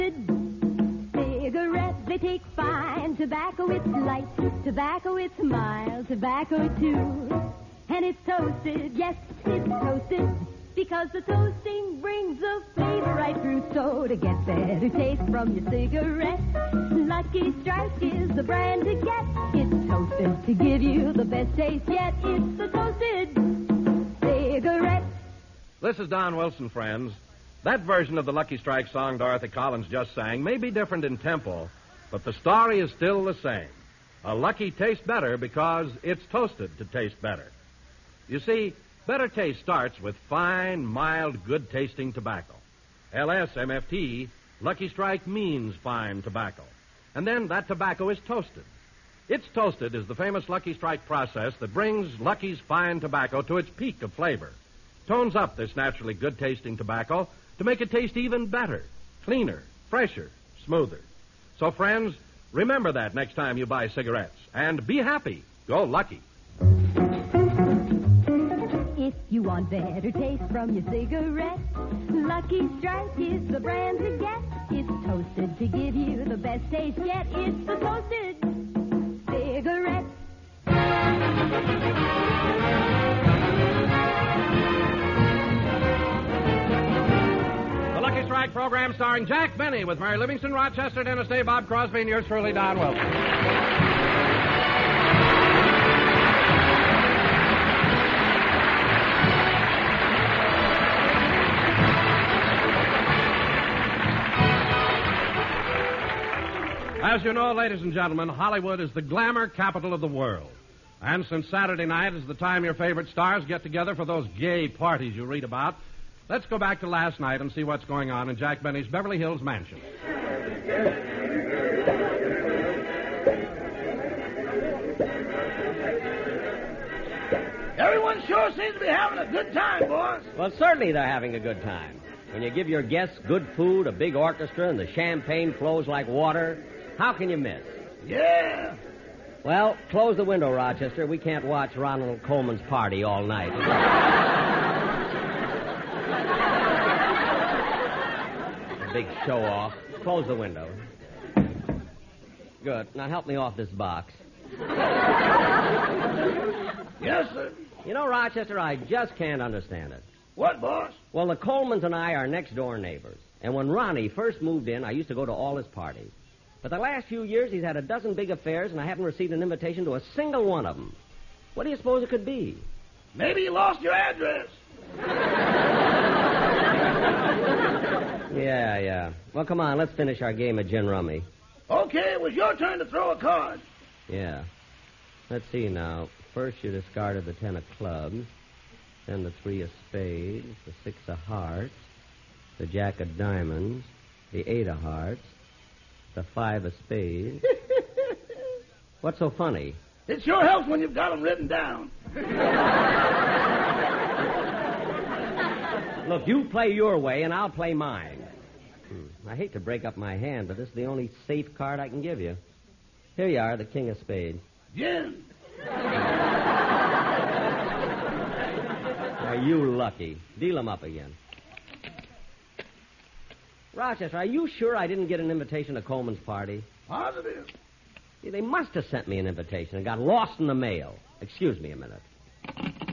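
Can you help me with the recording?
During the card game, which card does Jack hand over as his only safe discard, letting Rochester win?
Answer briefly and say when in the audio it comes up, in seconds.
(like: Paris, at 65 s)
king of spades, at 213 s.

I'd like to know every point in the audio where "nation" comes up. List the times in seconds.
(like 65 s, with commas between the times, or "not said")
not said.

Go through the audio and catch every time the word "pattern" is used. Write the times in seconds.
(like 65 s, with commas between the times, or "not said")
not said.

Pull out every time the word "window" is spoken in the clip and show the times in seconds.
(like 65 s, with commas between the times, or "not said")
140 s, 150 s.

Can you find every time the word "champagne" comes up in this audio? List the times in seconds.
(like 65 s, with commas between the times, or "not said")
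134 s.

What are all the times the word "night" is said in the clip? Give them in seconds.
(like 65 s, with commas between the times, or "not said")
111 s, 117 s, 143 s.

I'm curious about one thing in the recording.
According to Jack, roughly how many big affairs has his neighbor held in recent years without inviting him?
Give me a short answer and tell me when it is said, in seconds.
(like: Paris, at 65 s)
a dozen, at 167 s.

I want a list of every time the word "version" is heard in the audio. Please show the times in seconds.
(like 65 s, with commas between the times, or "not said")
27 s.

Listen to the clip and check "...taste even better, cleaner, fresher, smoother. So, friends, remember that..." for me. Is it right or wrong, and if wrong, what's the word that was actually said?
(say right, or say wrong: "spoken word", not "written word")
right.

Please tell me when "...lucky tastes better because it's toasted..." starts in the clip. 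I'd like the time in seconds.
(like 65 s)
34 s.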